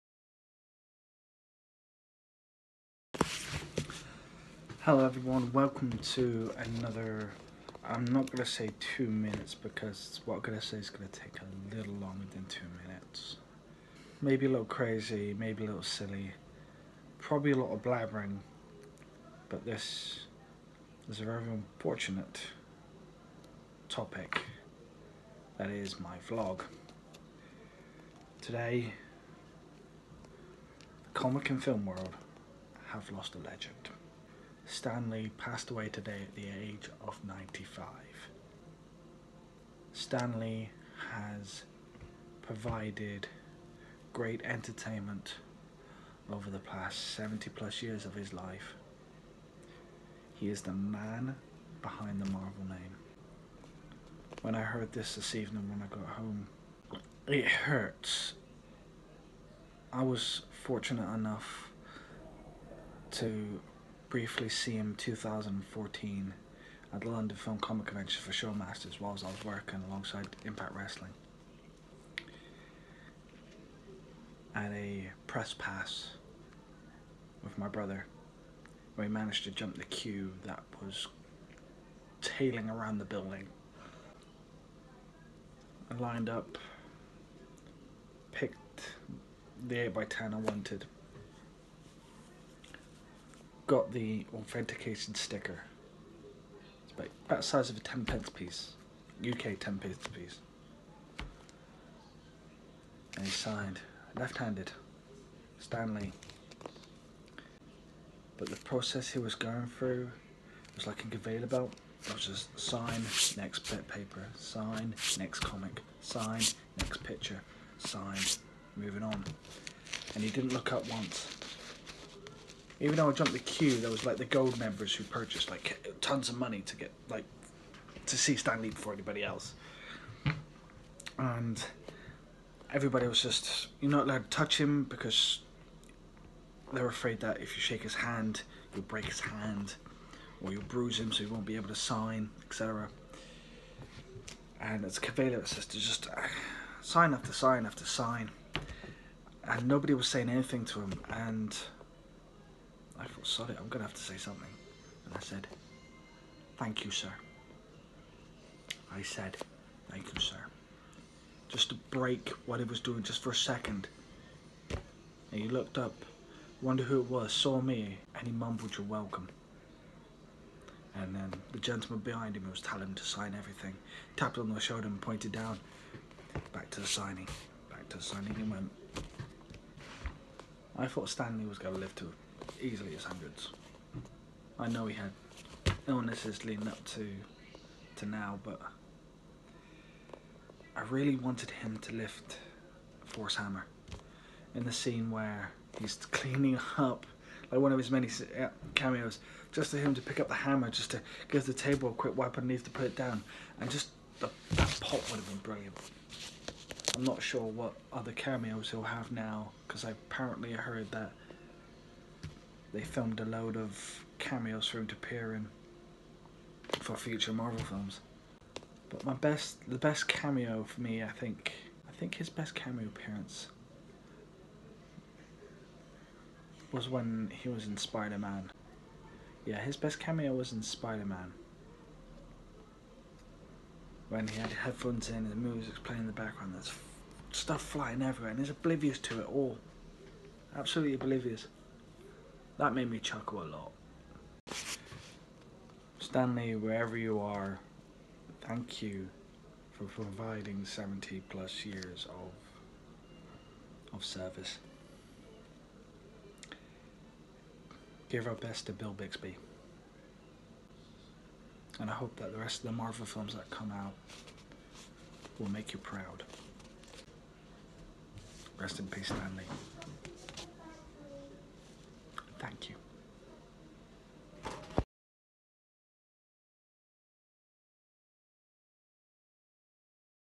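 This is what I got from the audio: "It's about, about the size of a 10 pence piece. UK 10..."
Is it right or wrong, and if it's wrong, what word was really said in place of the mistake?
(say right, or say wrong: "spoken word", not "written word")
right.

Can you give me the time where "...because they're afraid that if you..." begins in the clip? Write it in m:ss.
2:14.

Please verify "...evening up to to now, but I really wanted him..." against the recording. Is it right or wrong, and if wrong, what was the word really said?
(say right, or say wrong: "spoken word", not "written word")
wrong: "leading", not "evening".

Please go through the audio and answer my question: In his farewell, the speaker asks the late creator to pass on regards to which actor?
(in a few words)
Bill Bixby.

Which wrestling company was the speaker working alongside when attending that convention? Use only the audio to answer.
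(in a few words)
Impact Wrestling.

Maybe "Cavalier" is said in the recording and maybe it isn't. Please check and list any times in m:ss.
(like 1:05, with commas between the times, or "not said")
2:24.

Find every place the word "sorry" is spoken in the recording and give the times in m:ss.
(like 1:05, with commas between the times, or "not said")
2:33.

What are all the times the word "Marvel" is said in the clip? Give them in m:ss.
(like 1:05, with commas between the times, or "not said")
0:52, 3:37, 4:22.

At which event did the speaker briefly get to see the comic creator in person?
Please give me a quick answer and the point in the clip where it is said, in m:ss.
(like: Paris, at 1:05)
London Film Comic Convention, at 1:07.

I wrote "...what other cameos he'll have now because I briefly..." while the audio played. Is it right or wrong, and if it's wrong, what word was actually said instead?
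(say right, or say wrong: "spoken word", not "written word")
wrong: "apparently", not "briefly".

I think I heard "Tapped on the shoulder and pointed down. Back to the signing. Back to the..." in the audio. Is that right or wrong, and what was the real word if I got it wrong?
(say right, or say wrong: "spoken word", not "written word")
right.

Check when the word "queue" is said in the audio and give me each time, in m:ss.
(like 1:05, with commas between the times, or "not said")
1:19, 2:03.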